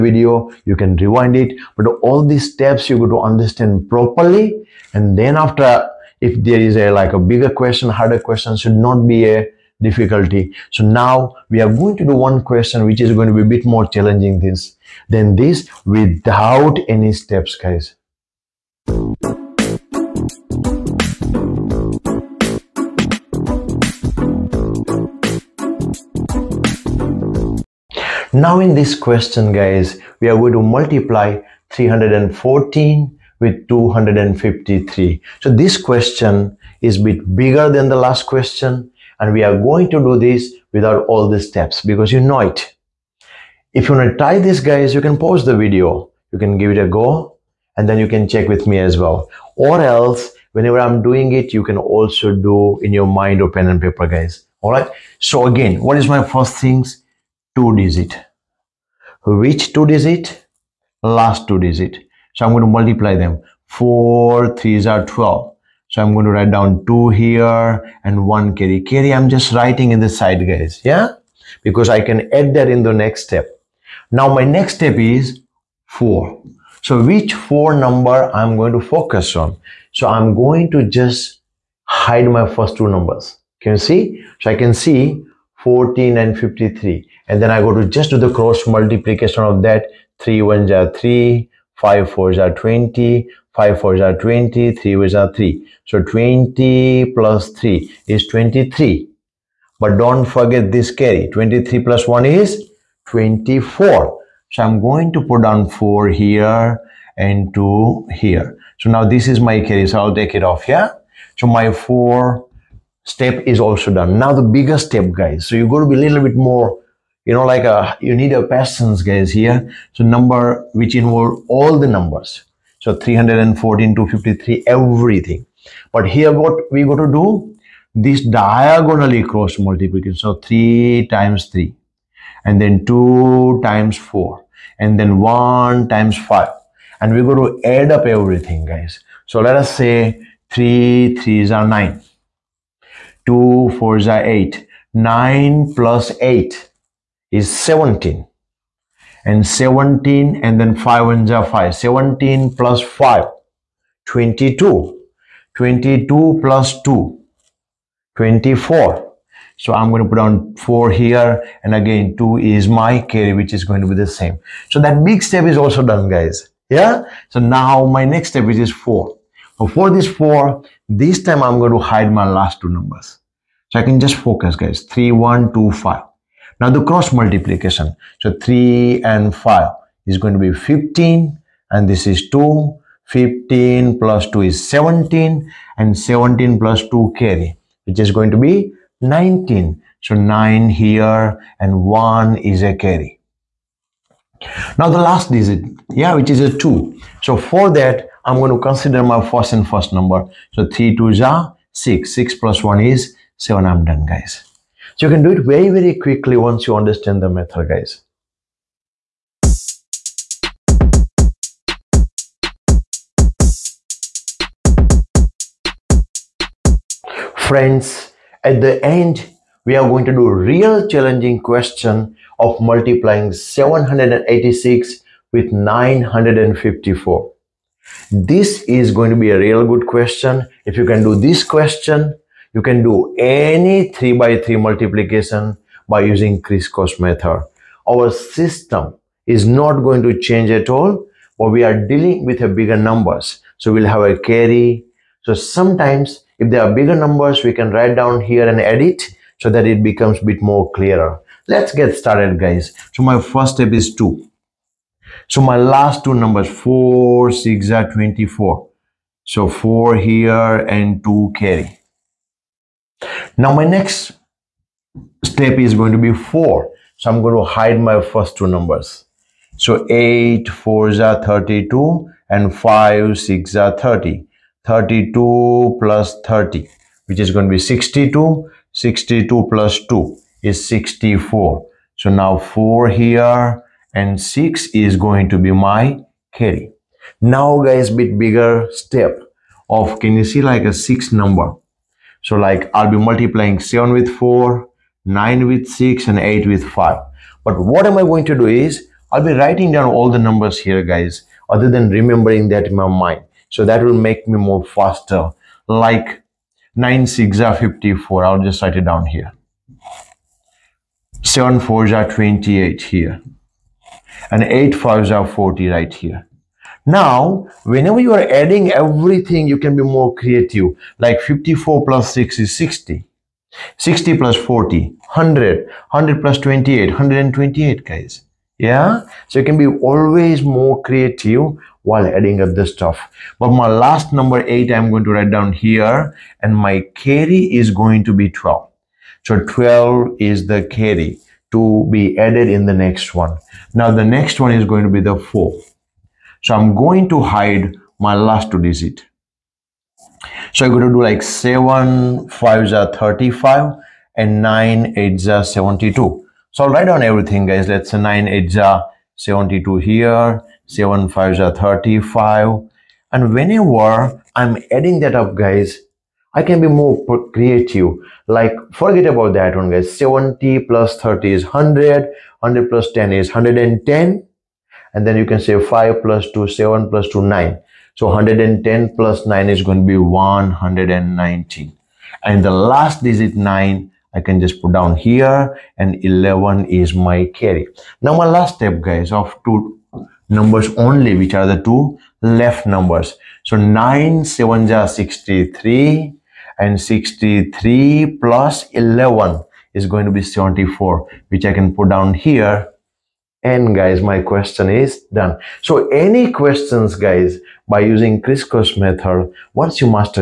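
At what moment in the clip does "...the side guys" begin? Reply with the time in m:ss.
1:10.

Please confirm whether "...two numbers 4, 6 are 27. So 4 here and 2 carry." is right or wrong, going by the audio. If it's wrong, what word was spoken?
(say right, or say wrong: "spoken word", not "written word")
wrong: "24", not "27".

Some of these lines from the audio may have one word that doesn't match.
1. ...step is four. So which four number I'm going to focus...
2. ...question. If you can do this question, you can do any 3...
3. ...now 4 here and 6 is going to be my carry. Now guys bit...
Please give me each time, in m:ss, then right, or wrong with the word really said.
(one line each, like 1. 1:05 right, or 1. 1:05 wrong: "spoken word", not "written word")
1. 1:14 right
2. 3:49 right
3. 4:42 right.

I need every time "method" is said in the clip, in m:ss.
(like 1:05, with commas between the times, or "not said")
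3:27, 3:57, 6:48.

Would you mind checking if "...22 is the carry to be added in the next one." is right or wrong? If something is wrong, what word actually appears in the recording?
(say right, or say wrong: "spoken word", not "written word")
wrong: "12", not "22".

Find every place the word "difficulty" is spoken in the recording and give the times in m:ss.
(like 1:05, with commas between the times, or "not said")
0:09.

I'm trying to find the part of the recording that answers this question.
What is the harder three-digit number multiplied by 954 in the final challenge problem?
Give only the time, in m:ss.
3:43.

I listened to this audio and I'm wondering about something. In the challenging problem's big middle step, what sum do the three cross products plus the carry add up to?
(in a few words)
128.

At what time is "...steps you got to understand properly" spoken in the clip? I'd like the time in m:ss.
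0:02.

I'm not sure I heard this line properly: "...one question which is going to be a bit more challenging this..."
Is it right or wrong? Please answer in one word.
right.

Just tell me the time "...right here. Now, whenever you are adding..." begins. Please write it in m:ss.
5:15.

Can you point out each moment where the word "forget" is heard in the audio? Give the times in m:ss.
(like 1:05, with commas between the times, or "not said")
1:40, 6:08.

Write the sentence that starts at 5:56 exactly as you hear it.
So I'll write down everything guys.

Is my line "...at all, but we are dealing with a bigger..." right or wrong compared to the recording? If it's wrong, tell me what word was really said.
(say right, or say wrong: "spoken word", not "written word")
right.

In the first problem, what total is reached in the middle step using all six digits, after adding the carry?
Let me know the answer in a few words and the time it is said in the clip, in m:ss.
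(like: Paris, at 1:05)
24, at 2:35.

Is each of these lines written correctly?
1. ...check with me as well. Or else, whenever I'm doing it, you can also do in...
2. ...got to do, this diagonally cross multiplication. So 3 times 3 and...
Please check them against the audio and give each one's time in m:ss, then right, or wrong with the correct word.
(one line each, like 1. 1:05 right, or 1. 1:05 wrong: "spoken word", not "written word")
1. 0:48 right
2. 2:06 right.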